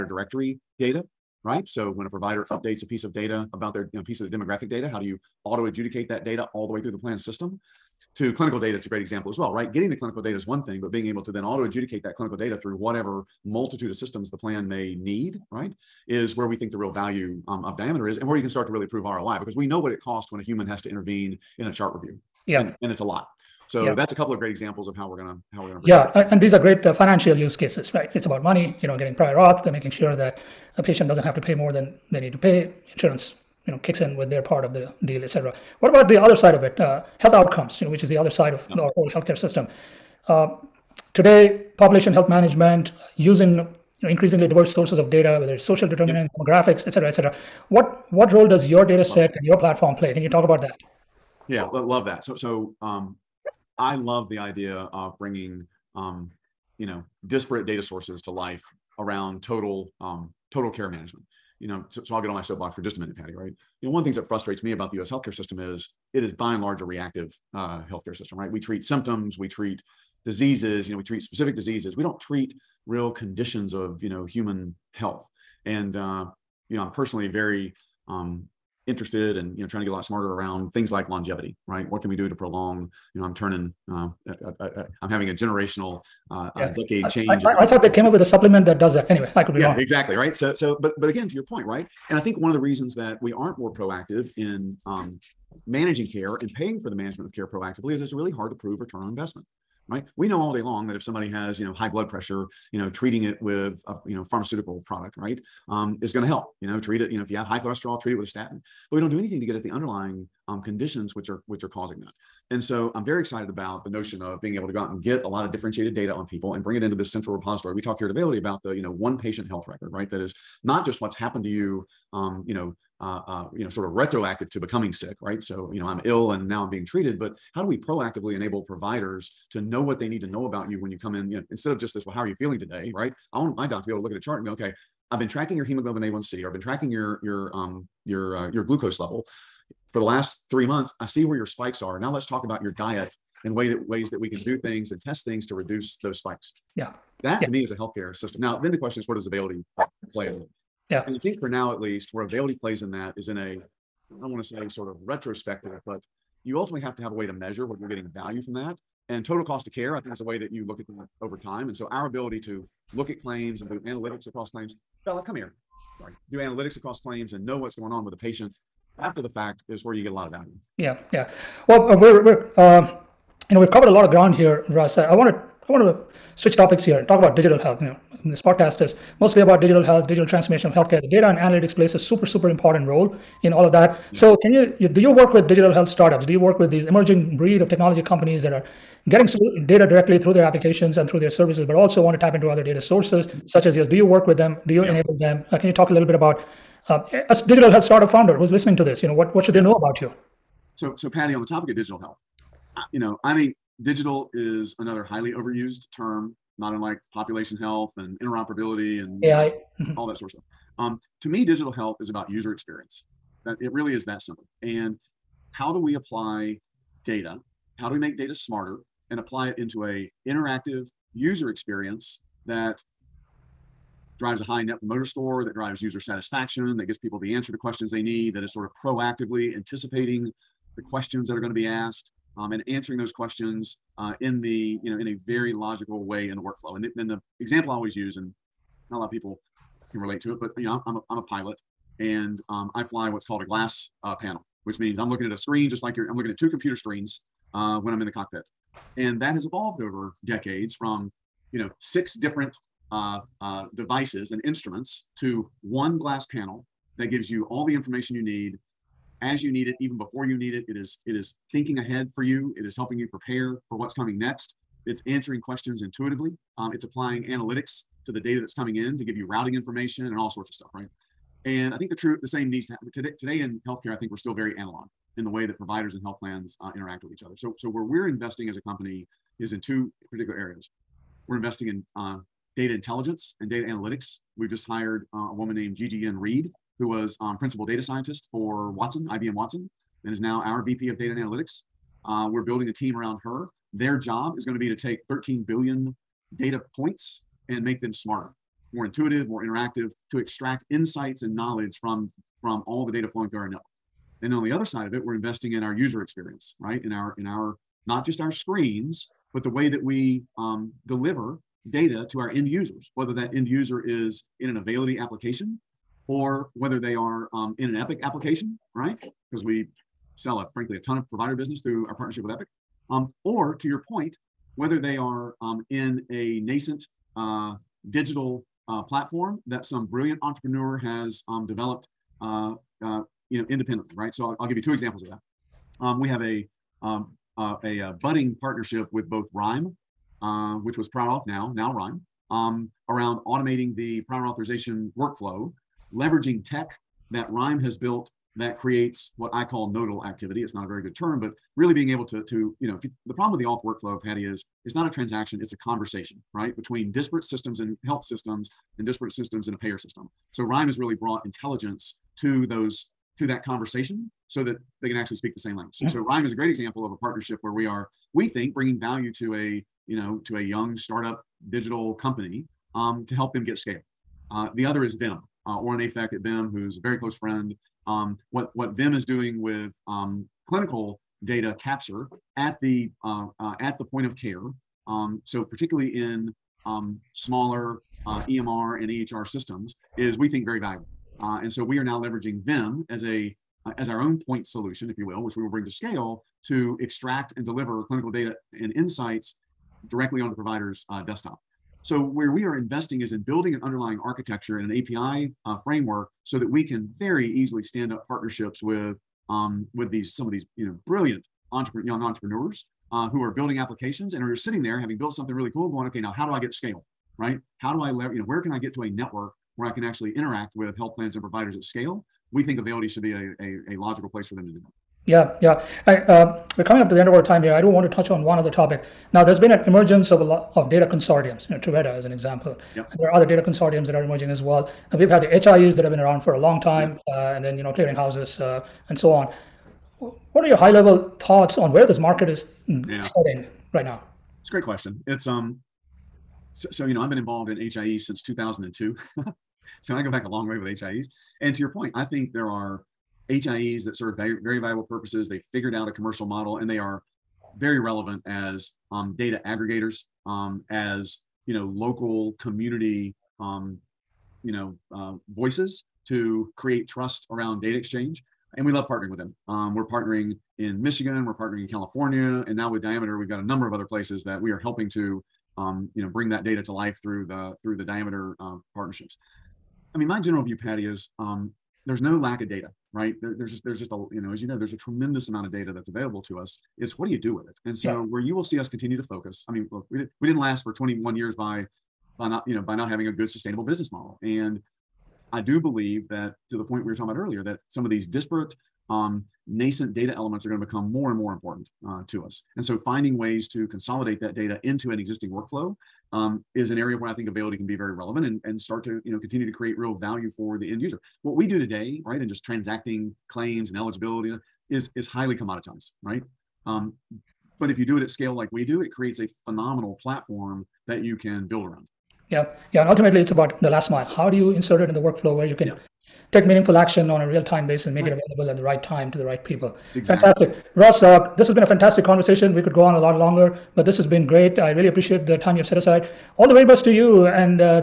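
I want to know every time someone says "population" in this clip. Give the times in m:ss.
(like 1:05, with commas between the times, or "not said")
0:41, 3:27.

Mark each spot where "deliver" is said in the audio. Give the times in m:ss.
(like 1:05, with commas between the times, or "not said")
5:10, 6:37.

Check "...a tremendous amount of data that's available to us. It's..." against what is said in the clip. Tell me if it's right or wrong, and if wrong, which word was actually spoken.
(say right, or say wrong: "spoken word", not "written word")
right.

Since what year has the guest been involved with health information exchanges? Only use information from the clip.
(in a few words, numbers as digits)
2002.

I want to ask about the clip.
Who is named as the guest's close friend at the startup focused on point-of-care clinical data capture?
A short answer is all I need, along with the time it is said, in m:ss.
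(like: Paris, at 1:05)
Oron Afek, at 6:15.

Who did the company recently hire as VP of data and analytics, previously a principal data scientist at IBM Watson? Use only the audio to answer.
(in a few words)
Gigi Yen Reed.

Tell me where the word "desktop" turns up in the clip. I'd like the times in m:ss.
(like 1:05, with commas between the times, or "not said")
6:41.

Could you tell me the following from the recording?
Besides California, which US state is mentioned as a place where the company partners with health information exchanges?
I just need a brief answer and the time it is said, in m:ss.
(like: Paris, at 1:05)
Michigan, at 7:50.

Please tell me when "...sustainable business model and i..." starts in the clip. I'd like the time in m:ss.
8:13.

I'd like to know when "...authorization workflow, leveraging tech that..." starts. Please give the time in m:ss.
5:44.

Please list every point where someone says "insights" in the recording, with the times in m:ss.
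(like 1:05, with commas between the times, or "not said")
5:00, 6:38.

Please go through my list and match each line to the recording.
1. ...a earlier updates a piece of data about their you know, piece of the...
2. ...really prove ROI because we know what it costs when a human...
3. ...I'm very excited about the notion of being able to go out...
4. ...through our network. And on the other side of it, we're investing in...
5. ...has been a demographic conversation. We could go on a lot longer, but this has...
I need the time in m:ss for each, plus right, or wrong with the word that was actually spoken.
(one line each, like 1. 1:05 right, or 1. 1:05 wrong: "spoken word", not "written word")
1. 0:02 wrong: "provider", not "earlier"
2. 0:18 right
3. 1:52 right
4. 5:03 right
5. 8:51 wrong: "fantastic", not "demographic".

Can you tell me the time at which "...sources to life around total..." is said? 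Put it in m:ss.
0:57.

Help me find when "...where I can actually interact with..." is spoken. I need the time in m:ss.
6:59.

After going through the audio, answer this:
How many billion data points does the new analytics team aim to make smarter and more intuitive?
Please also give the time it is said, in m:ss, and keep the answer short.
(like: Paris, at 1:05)
13, at 4:55.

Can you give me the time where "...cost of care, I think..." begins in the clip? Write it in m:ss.
2:39.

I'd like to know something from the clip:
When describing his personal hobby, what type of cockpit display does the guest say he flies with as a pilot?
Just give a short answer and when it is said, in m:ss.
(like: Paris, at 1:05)
Glass panel, at 4:03.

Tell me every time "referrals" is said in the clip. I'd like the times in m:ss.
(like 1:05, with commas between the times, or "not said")
not said.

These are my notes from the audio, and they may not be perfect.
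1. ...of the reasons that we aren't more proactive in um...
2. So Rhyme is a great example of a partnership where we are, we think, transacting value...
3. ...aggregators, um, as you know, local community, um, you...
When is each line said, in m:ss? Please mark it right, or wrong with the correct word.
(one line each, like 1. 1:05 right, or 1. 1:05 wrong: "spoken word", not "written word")
1. 1:32 right
2. 6:05 wrong: "bringing", not "transacting"
3. 7:39 right.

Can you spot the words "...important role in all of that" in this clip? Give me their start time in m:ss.
3:02.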